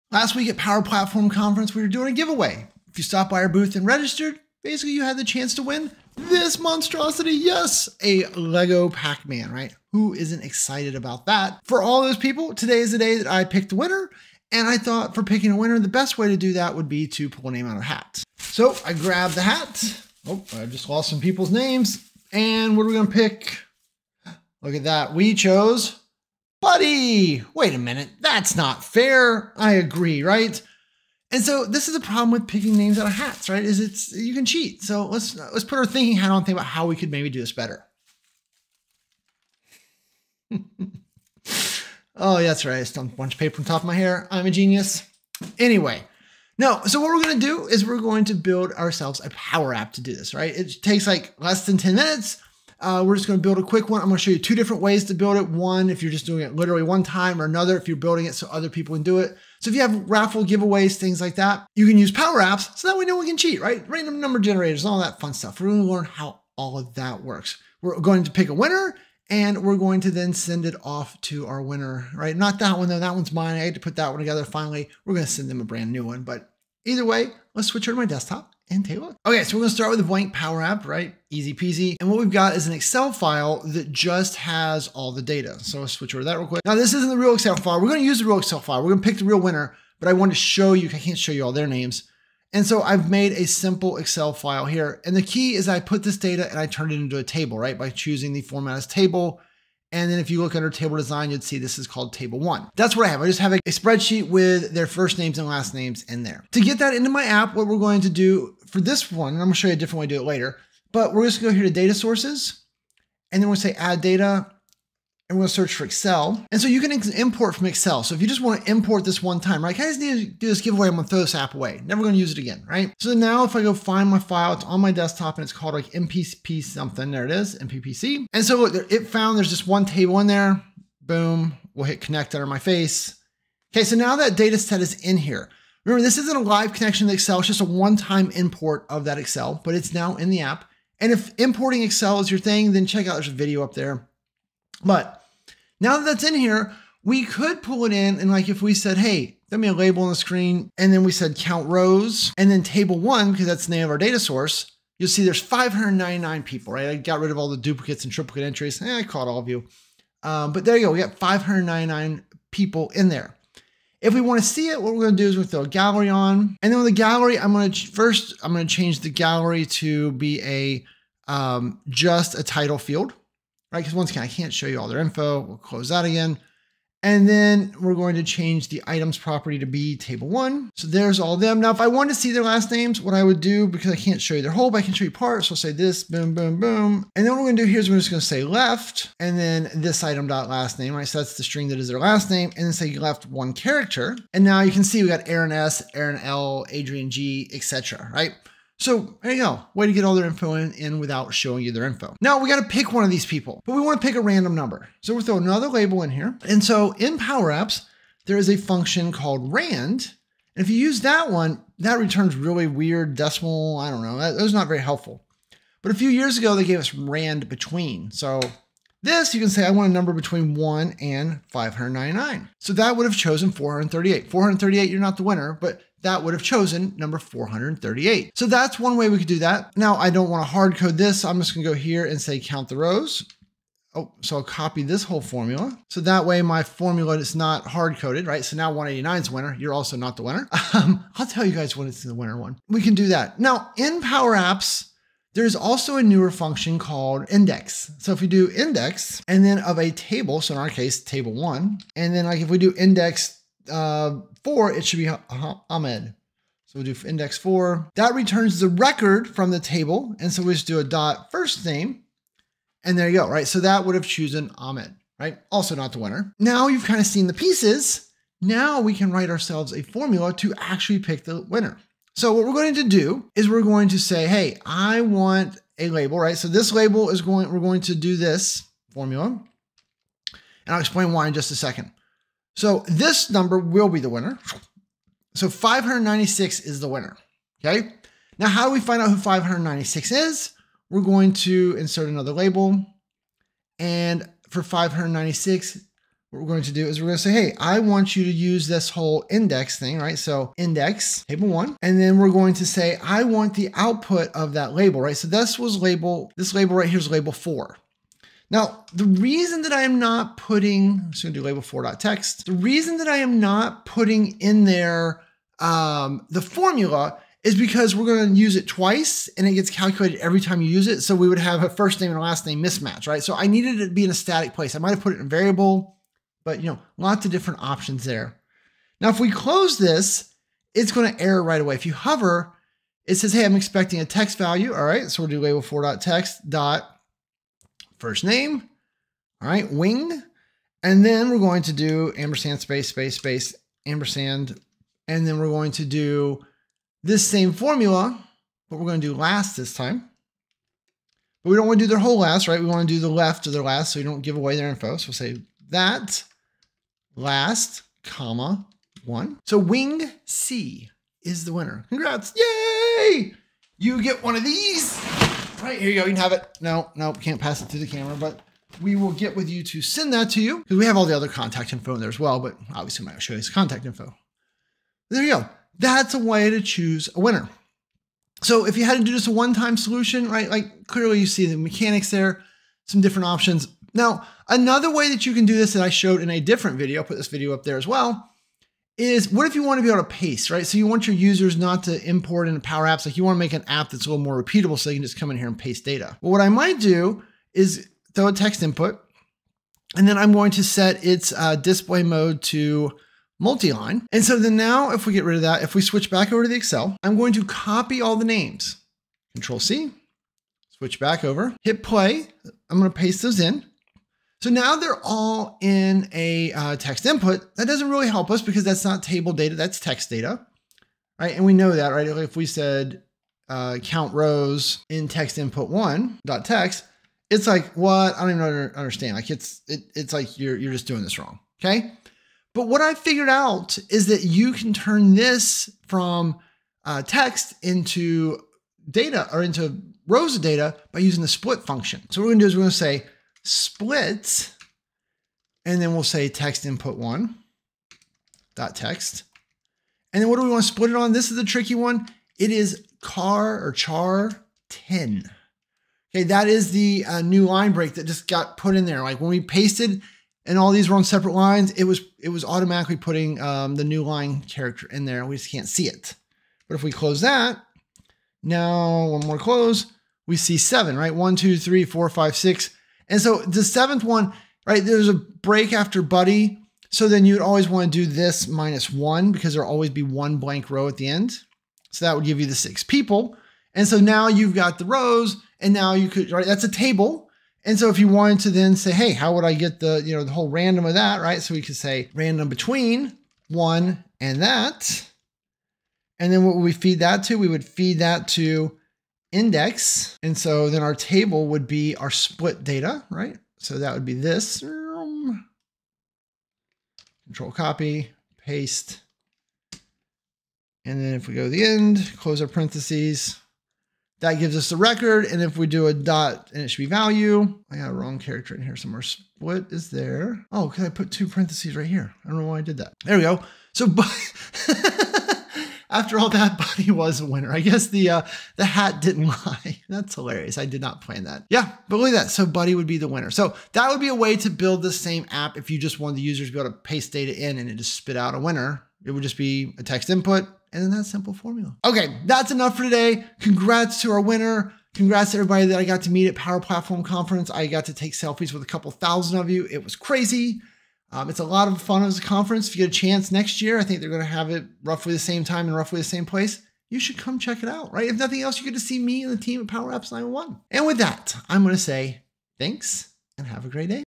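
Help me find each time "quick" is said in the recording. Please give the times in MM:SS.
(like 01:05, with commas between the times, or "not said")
00:53, 01:26.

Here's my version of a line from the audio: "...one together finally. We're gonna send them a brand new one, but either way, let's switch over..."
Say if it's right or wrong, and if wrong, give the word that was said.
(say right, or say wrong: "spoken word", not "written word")
right.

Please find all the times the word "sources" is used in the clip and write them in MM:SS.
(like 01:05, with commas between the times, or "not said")
01:51, 02:34.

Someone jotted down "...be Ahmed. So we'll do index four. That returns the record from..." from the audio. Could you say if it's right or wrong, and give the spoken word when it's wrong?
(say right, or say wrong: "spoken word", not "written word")
right.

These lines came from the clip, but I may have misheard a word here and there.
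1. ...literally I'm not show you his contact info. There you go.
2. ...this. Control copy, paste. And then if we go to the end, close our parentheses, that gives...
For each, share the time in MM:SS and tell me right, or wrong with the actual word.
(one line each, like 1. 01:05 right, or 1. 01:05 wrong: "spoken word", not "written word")
1. 06:12 wrong: "obviously", not "literally"
2. 08:24 right.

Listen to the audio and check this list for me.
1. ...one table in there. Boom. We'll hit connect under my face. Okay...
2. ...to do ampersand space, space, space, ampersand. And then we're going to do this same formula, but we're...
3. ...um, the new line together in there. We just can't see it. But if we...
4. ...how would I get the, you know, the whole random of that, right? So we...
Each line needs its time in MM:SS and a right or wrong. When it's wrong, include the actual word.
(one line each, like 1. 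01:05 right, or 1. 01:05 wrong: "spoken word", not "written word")
1. 02:09 right
2. 05:41 right
3. 07:43 wrong: "character", not "together"
4. 08:09 right.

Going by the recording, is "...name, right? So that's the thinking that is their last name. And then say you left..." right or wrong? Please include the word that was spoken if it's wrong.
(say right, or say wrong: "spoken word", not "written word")
wrong: "string", not "thinking".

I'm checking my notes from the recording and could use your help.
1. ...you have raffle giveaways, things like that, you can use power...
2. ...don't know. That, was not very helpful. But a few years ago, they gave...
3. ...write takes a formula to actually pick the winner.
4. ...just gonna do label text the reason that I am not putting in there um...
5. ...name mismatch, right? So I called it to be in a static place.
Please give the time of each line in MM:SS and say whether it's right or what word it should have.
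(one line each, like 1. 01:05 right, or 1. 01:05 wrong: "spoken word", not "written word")
1. 00:59 right
2. 03:33 right
3. 04:29 wrong: "ourselves", not "takes"
4. 05:11 right
5. 05:22 wrong: "needed", not "called".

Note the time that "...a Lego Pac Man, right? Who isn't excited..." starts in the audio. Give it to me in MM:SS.
00:08.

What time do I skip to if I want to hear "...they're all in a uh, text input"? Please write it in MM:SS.
06:54.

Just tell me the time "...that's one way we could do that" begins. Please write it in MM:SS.
03:48.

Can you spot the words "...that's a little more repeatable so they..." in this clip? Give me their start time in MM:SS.
06:33.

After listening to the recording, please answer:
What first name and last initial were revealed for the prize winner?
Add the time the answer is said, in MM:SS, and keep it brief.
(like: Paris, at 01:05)
Wing C, at 05:59.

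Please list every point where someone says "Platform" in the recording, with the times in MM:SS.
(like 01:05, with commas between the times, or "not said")
00:00, 09:06.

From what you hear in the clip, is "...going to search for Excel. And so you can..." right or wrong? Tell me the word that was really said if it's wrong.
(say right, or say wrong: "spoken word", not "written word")
right.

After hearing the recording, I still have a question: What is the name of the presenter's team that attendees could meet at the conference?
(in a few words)
Power Apps 911.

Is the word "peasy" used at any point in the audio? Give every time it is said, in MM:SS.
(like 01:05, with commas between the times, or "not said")
01:21.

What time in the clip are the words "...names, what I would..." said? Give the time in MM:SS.
03:02.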